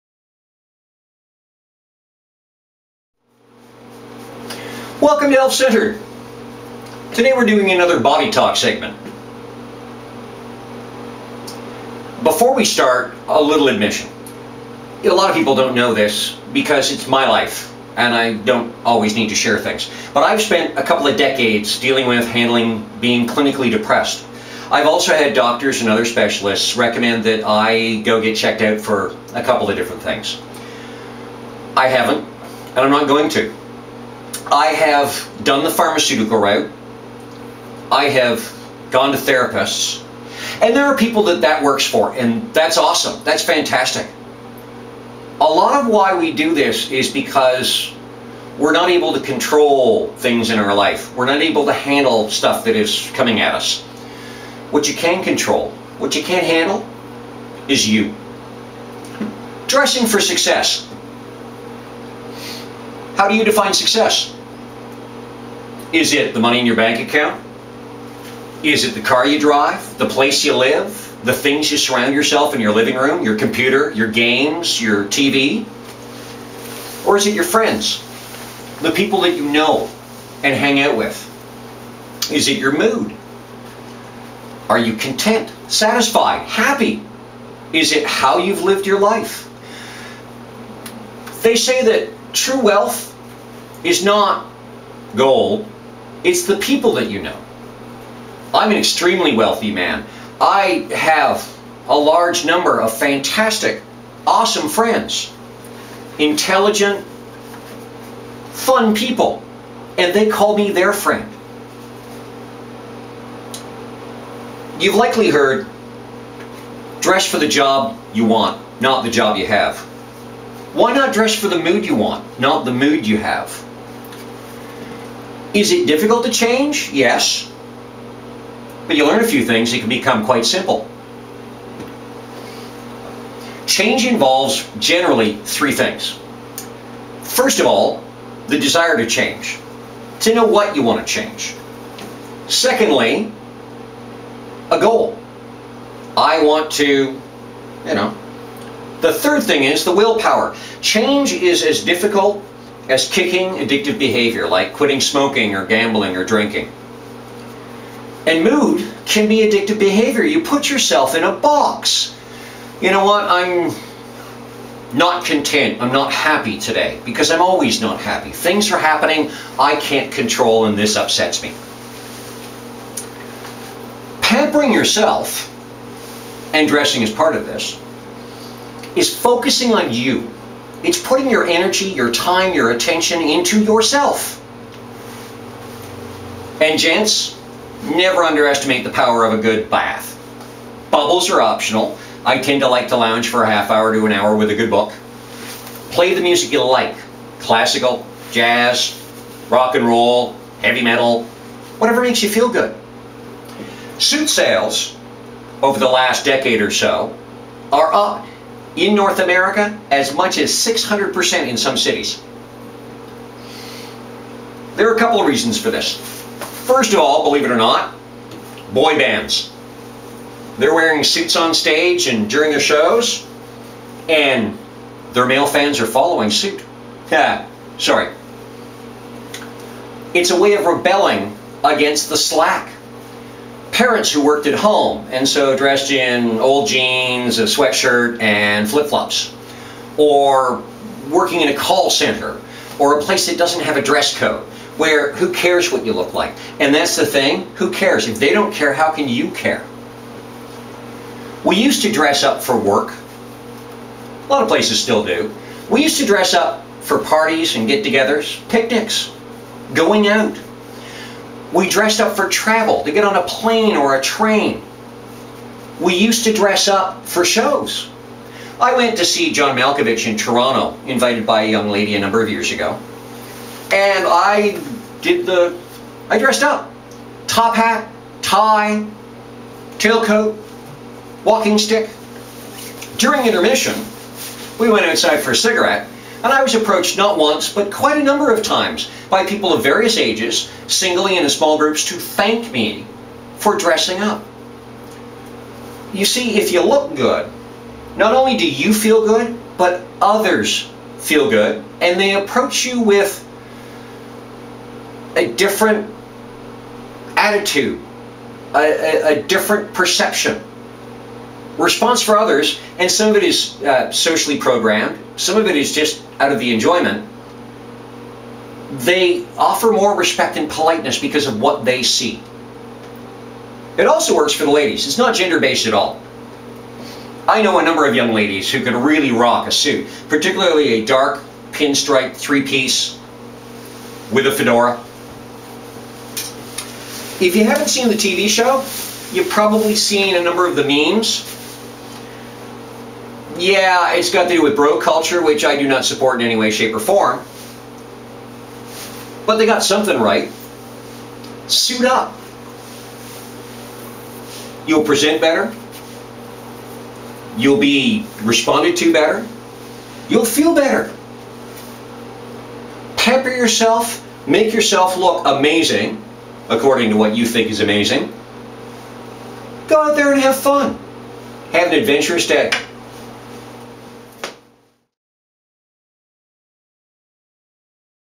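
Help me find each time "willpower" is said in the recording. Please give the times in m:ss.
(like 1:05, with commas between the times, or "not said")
2:29.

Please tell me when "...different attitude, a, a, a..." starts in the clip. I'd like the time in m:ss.
5:05.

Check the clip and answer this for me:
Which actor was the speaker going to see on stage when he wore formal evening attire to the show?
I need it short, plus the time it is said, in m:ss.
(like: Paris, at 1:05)
John Malkovich, at 4:29.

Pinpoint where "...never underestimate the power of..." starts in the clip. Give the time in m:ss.
3:07.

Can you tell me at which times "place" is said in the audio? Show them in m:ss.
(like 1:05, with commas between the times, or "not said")
1:10, 4:03, 4:14.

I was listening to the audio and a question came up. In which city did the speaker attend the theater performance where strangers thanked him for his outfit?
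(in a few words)
Toronto.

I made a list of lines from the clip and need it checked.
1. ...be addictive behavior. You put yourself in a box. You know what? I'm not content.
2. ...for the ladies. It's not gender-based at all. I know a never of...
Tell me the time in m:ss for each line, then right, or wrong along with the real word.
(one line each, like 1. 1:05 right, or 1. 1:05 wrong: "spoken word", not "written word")
1. 2:39 right
2. 5:24 wrong: "number", not "never".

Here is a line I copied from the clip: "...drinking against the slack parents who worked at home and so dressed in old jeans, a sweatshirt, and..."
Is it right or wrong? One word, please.
wrong.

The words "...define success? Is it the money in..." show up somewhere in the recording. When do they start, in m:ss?
1:03.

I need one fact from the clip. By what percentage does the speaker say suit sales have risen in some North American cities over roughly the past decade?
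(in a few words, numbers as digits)
600%.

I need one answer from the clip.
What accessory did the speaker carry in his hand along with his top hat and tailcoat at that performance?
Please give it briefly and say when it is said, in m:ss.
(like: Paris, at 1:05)
walking stick, at 4:41.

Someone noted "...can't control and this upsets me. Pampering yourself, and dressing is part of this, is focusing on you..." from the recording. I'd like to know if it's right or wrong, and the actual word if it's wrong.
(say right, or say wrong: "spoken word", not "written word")
right.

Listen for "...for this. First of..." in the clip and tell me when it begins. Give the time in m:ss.
3:35.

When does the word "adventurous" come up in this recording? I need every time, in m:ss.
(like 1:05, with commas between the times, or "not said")
6:11.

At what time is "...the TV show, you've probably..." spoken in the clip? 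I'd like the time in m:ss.
5:37.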